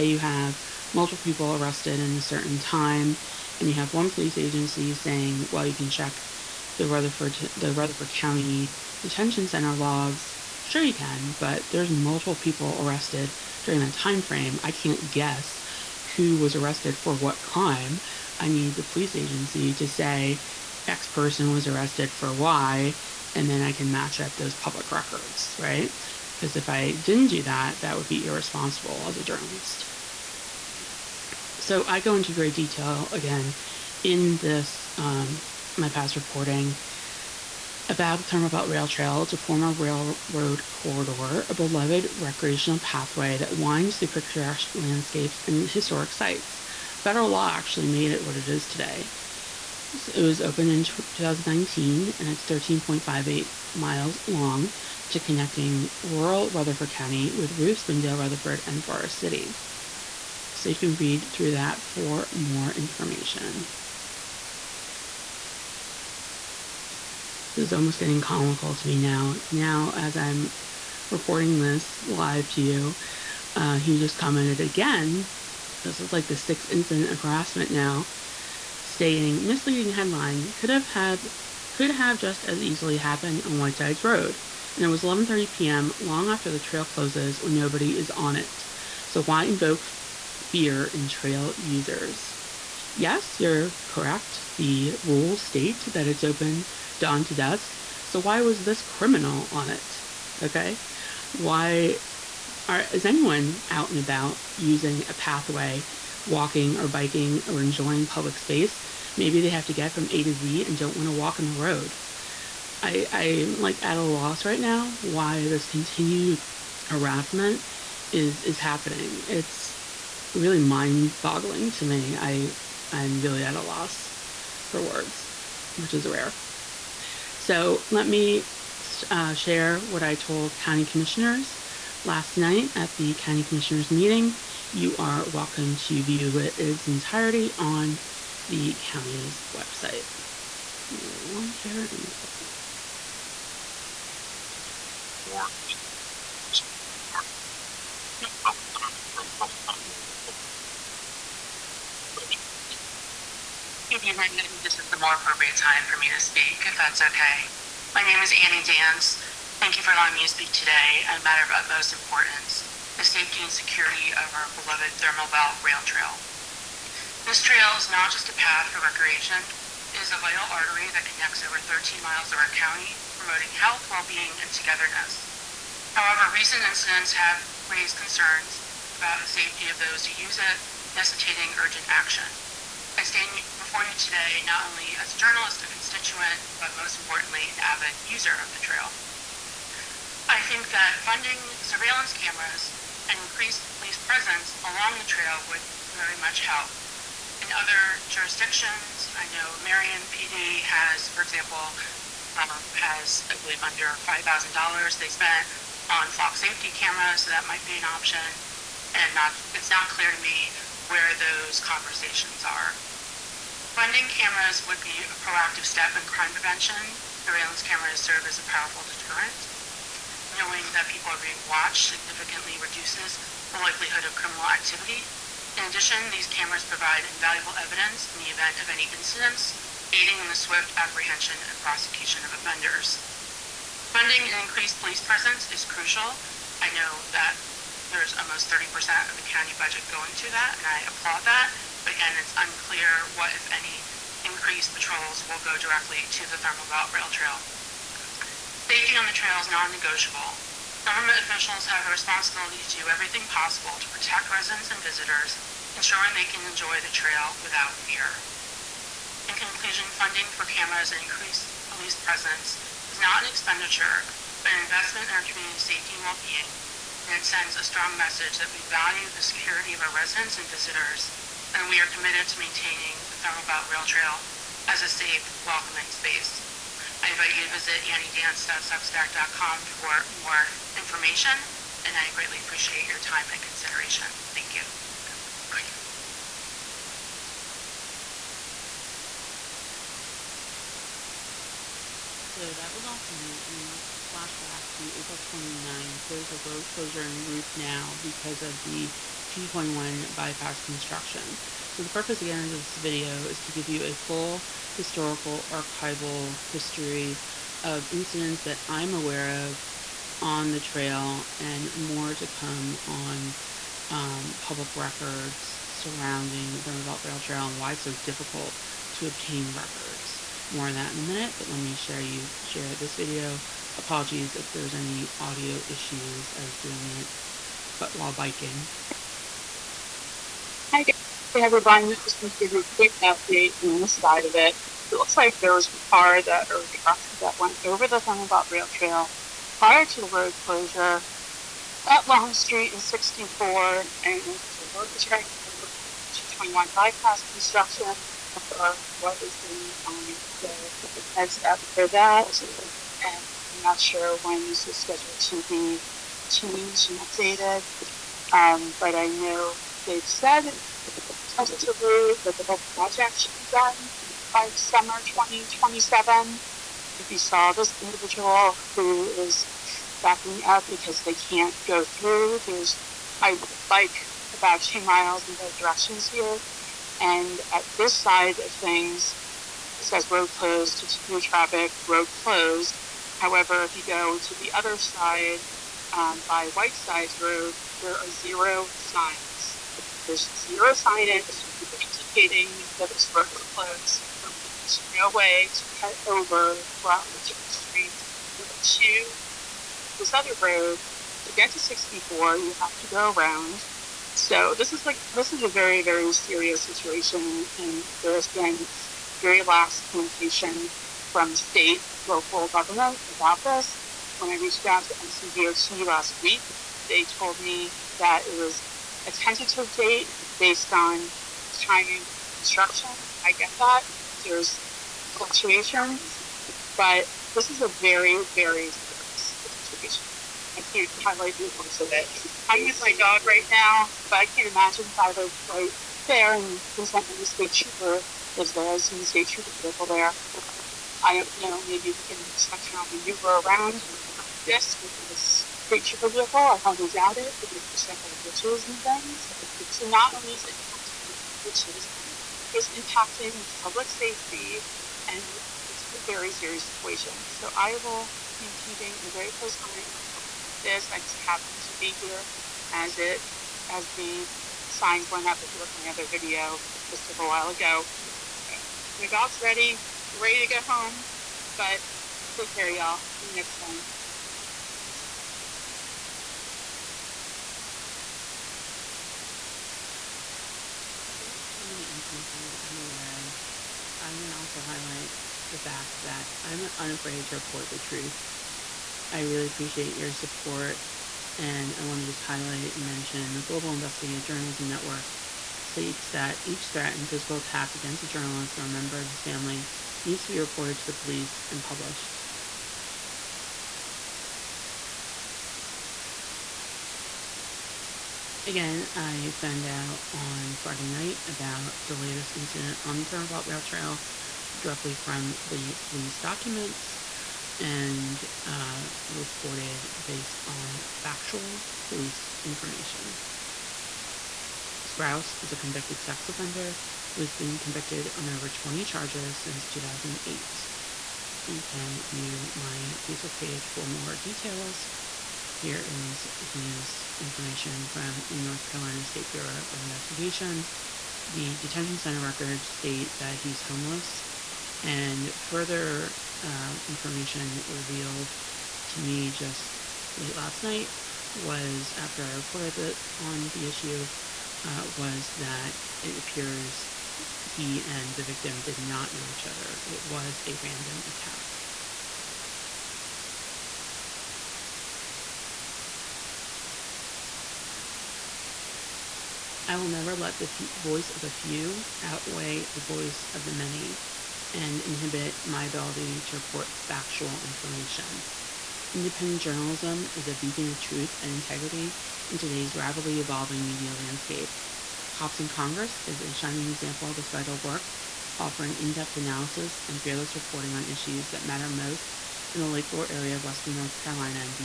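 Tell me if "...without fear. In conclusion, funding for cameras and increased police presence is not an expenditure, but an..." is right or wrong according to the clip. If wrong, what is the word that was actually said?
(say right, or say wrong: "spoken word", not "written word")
right.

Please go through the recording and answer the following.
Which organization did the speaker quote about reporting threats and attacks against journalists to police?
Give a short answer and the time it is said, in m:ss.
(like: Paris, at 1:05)
Global Investigative Journalism Network, at 8:13.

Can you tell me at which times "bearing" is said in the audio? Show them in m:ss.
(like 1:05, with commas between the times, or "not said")
not said.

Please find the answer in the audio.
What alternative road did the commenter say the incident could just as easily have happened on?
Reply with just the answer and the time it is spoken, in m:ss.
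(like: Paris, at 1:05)
Whitesides Road, at 1:23.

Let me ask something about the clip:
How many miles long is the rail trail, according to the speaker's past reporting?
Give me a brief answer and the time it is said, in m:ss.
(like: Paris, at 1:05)
13.58 miles, at 0:52.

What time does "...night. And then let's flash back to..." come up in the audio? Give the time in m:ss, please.
4:53.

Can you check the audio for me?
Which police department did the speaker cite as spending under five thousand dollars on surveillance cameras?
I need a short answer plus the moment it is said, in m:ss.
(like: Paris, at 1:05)
Marion PD, at 3:19.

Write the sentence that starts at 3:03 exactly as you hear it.
I stand before you today not only as a journalist, a constituent, but most importantly, an avid user of the trail.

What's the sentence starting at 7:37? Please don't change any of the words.
So I will be keeping a very close eye on this.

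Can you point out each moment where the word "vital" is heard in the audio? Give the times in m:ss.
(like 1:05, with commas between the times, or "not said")
2:50, 9:47.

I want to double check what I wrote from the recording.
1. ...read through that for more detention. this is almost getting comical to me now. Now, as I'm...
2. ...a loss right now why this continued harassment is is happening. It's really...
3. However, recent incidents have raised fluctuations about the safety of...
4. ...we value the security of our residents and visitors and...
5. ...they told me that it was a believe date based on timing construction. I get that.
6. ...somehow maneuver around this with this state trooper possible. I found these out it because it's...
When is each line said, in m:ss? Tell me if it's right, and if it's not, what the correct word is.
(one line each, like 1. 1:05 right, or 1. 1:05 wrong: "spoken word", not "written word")
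1. 1:00 wrong: "information", not "detention"
2. 1:53 right
3. 2:55 wrong: "concerns", not "fluctuations"
4. 4:28 right
5. 6:56 wrong: "tentative", not "believe"
6. 7:22 wrong: "vehicle", not "possible".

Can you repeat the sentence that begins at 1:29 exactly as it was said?
So why invoke fear in trail users?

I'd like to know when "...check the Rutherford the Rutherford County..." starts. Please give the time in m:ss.
0:05.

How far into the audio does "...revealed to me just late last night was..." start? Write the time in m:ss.
9:07.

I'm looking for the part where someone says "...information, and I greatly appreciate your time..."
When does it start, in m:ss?
4:40.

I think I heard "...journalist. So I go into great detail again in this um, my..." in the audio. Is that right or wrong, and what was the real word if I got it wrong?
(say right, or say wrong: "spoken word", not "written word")
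right.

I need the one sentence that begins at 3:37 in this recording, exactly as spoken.
Surveillance cameras serve as a powerful deterrent.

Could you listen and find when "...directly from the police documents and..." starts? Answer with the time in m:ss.
8:34.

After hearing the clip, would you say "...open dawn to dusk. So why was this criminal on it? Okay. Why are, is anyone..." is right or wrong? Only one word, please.
right.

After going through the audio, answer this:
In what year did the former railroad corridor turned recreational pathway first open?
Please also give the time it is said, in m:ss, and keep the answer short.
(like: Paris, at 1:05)
2019, at 0:50.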